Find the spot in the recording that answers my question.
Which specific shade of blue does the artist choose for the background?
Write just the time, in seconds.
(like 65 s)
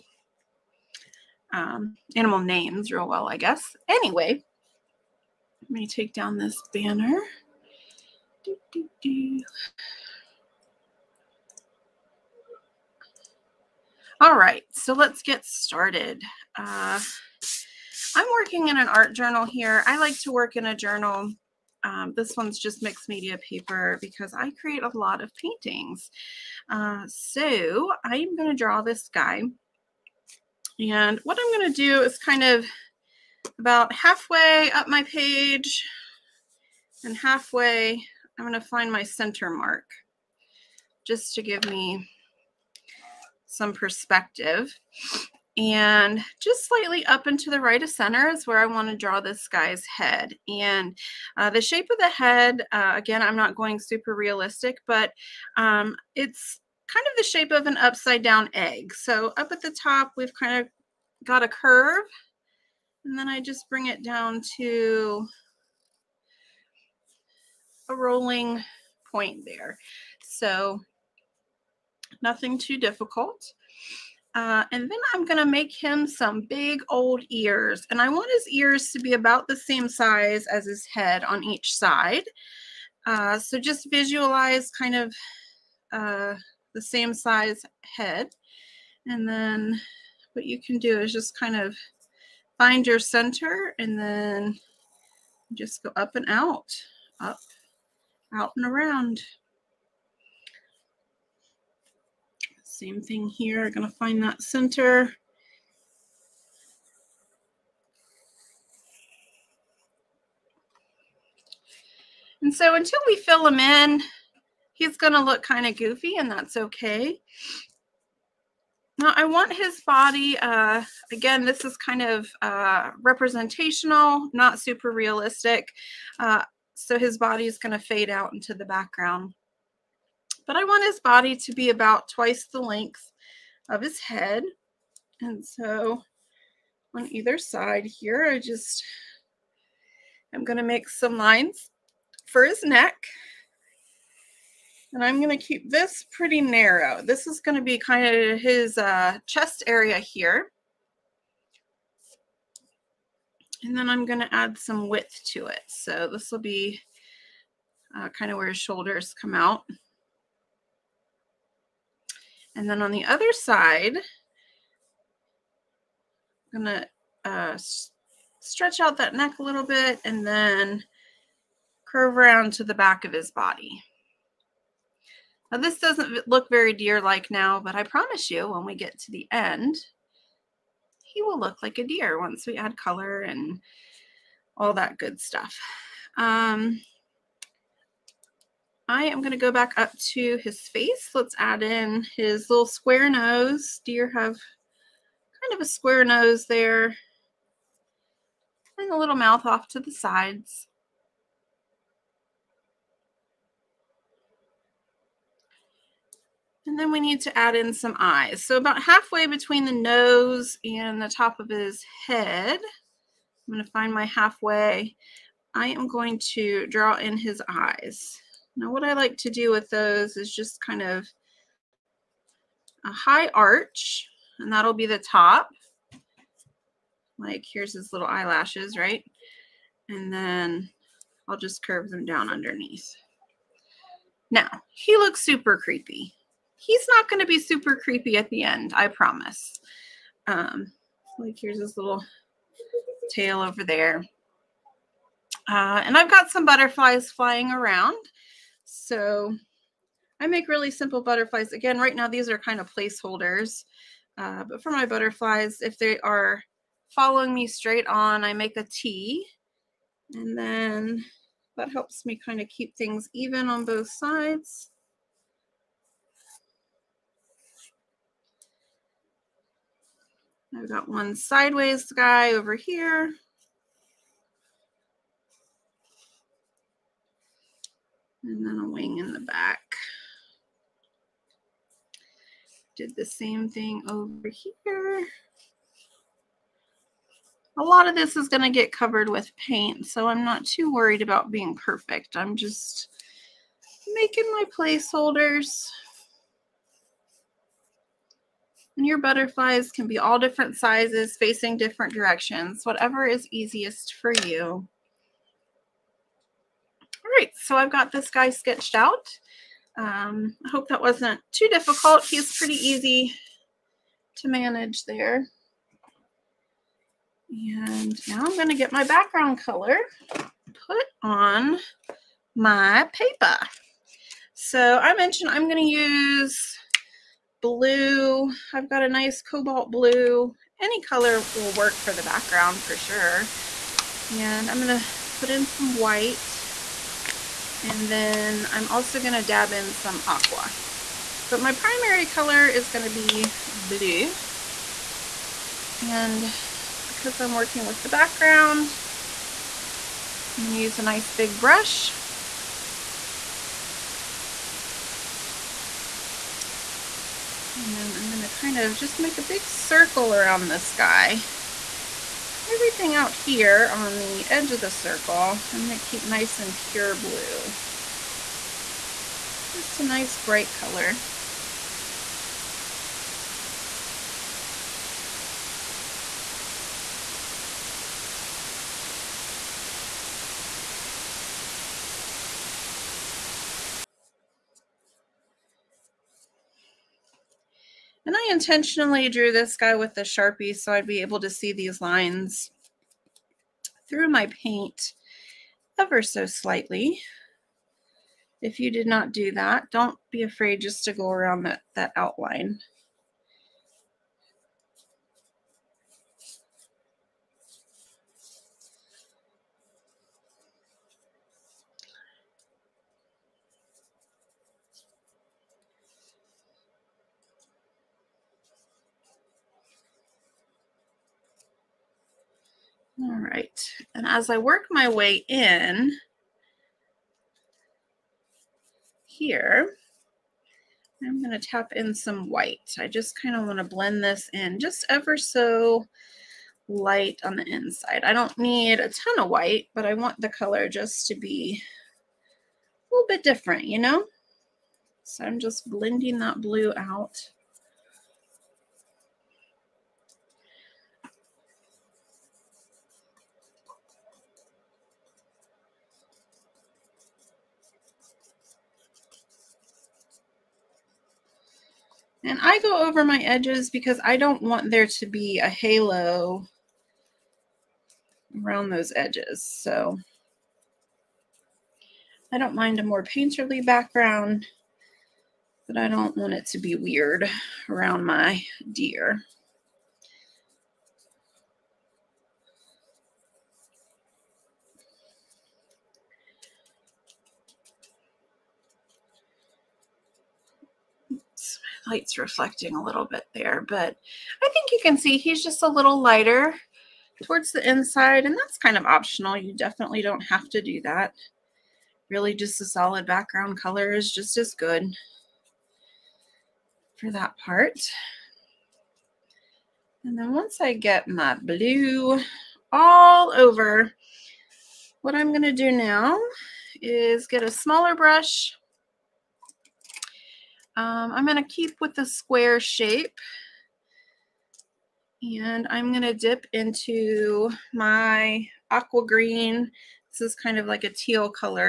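329 s.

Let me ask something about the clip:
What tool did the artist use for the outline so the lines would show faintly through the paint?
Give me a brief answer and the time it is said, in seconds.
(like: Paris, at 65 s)
Sharpie, at 390 s.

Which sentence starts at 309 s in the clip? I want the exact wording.
Um, I hope that wasn't too difficult.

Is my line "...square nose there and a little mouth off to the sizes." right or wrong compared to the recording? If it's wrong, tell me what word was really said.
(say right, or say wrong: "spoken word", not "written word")
wrong: "sides", not "sizes".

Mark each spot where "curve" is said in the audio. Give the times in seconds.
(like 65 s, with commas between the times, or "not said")
61 s, 171 s, 231 s.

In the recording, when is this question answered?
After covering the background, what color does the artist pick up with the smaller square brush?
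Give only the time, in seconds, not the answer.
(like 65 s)
528 s.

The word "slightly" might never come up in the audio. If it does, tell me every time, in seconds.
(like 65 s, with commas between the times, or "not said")
46 s, 396 s.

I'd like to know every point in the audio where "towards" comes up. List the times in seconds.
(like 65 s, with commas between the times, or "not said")
497 s.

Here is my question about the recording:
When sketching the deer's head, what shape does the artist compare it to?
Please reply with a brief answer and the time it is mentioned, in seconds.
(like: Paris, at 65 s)
Upside down egg, at 57 s.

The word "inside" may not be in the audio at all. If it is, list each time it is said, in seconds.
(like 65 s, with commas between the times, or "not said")
437 s, 497 s.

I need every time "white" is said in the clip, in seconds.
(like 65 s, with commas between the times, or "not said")
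335 s, 432 s, 439 s.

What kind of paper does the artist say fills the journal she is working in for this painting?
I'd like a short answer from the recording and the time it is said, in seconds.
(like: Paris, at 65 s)
Mixed media paper, at 22 s.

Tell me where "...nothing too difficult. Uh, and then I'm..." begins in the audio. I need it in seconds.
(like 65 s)
72 s.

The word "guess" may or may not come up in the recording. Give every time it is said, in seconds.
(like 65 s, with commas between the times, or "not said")
3 s.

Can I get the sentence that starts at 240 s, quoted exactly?
Um, like here's his little tail over there.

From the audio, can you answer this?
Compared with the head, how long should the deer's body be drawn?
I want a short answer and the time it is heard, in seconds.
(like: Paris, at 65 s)
Twice the length, at 132 s.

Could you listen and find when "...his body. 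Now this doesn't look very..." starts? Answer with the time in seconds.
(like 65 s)
173 s.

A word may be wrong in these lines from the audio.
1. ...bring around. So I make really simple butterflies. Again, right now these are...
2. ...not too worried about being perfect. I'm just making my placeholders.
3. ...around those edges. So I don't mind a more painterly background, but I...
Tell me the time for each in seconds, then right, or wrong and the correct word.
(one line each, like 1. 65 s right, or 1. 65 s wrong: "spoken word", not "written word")
1. 247 s wrong: "flying", not "bring"
2. 290 s right
3. 468 s right.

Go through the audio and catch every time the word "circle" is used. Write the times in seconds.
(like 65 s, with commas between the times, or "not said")
359 s, 364 s.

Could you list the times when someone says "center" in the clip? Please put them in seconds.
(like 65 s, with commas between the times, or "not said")
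39 s, 47 s, 92 s, 104 s.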